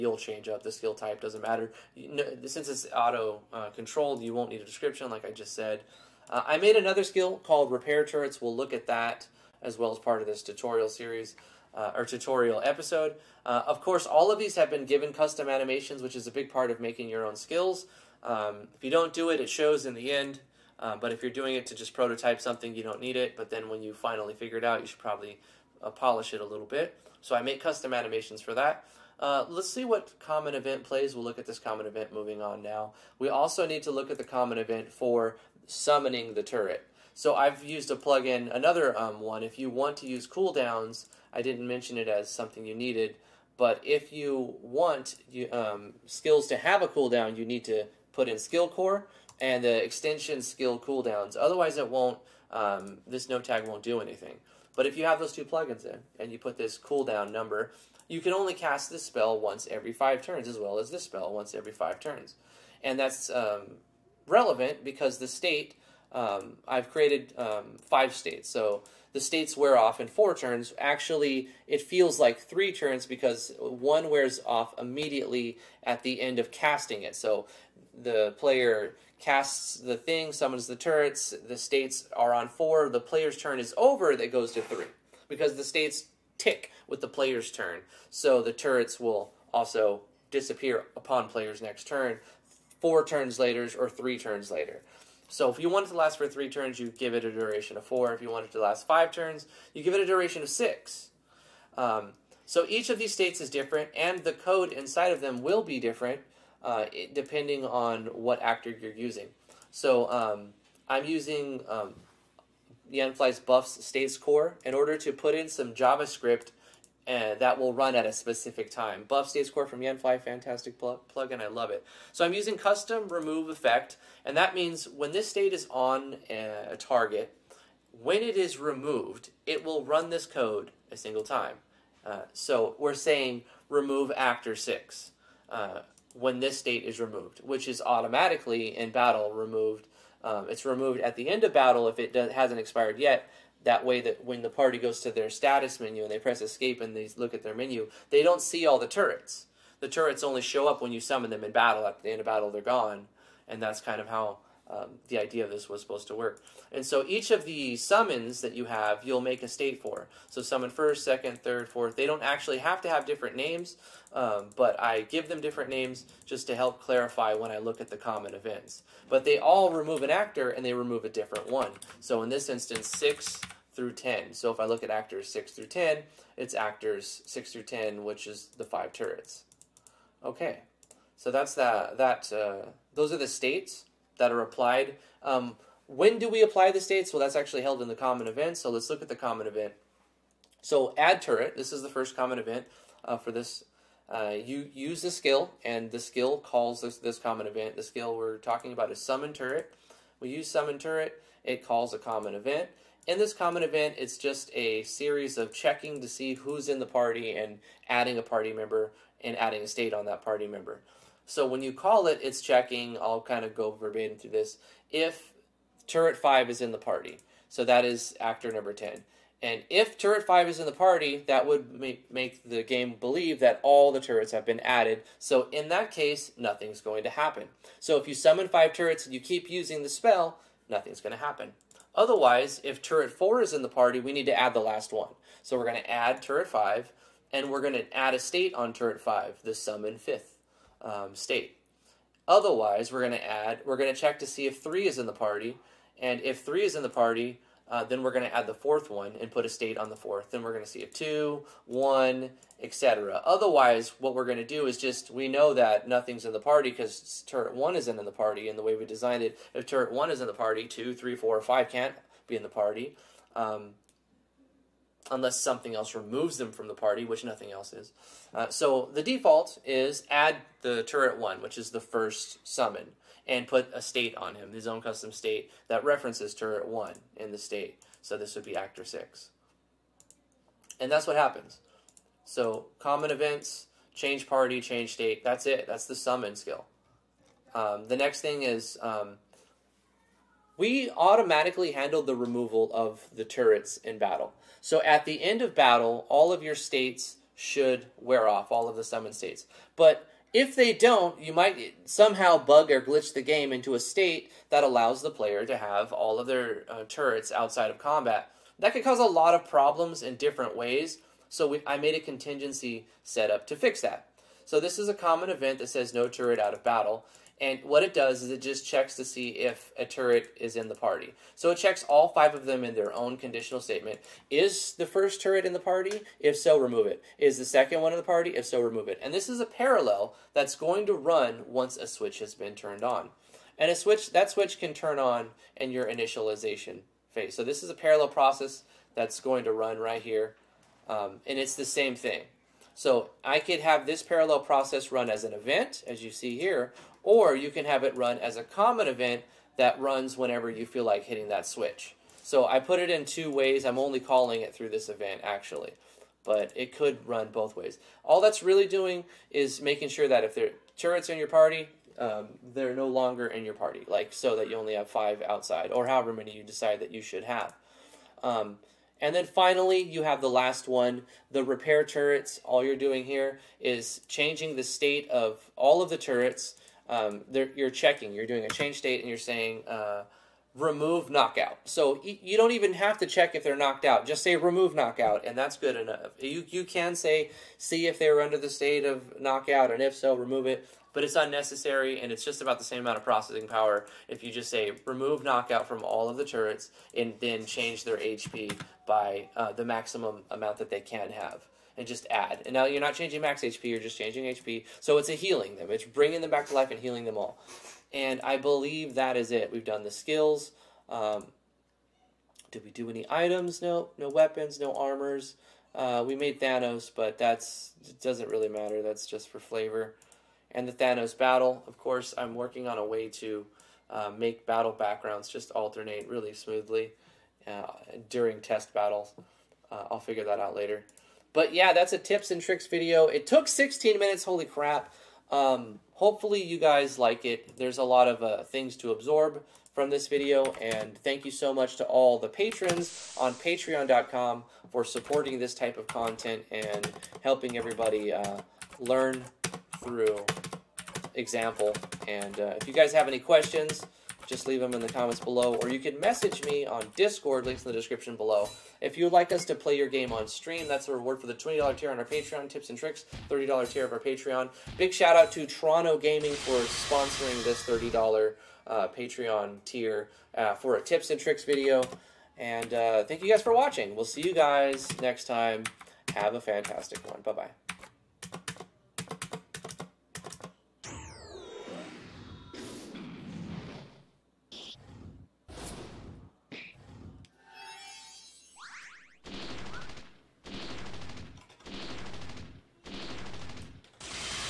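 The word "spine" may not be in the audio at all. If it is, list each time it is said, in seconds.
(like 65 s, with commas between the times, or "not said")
not said.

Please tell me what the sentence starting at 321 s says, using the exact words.
So it checks all five of them in their own conditional statement.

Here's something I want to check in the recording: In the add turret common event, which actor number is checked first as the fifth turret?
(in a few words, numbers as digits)
10.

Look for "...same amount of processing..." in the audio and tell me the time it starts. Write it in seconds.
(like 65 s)
392 s.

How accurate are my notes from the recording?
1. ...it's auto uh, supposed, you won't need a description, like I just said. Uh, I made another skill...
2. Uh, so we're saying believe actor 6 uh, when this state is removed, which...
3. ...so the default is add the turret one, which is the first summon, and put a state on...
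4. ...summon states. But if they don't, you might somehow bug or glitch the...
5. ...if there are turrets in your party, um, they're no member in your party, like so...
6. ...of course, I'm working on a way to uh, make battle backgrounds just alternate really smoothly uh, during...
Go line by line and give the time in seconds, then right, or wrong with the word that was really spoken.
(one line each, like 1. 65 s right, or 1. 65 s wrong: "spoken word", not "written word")
1. 2 s wrong: "controlled", not "supposed"
2. 132 s wrong: "remove", not "believe"
3. 268 s right
4. 298 s right
5. 360 s wrong: "longer", not "member"
6. 421 s right.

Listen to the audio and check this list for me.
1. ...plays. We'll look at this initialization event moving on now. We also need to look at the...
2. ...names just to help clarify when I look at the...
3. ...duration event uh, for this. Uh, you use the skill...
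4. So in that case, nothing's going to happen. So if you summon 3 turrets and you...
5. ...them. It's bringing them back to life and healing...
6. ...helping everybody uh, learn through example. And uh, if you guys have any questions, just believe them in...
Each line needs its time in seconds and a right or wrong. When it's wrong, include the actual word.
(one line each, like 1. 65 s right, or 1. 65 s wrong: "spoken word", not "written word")
1. 30 s wrong: "common", not "initialization"
2. 165 s right
3. 192 s wrong: "common", not "duration"
4. 225 s wrong: "5", not "3"
5. 405 s right
6. 447 s wrong: "leave", not "believe".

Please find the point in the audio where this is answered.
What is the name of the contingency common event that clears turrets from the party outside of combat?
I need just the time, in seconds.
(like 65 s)
315 s.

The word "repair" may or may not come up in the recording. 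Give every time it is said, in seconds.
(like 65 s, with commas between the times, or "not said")
7 s, 371 s.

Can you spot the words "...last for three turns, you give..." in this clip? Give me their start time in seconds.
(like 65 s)
95 s.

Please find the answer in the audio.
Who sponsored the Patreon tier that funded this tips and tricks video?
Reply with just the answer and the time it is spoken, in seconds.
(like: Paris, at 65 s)
Toronto Gaming, at 465 s.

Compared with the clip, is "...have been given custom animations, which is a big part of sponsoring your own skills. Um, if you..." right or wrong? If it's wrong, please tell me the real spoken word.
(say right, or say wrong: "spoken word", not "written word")
wrong: "making", not "sponsoring".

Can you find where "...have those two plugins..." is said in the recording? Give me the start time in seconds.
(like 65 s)
55 s.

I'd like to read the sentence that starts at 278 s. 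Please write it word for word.
So this would be actor six.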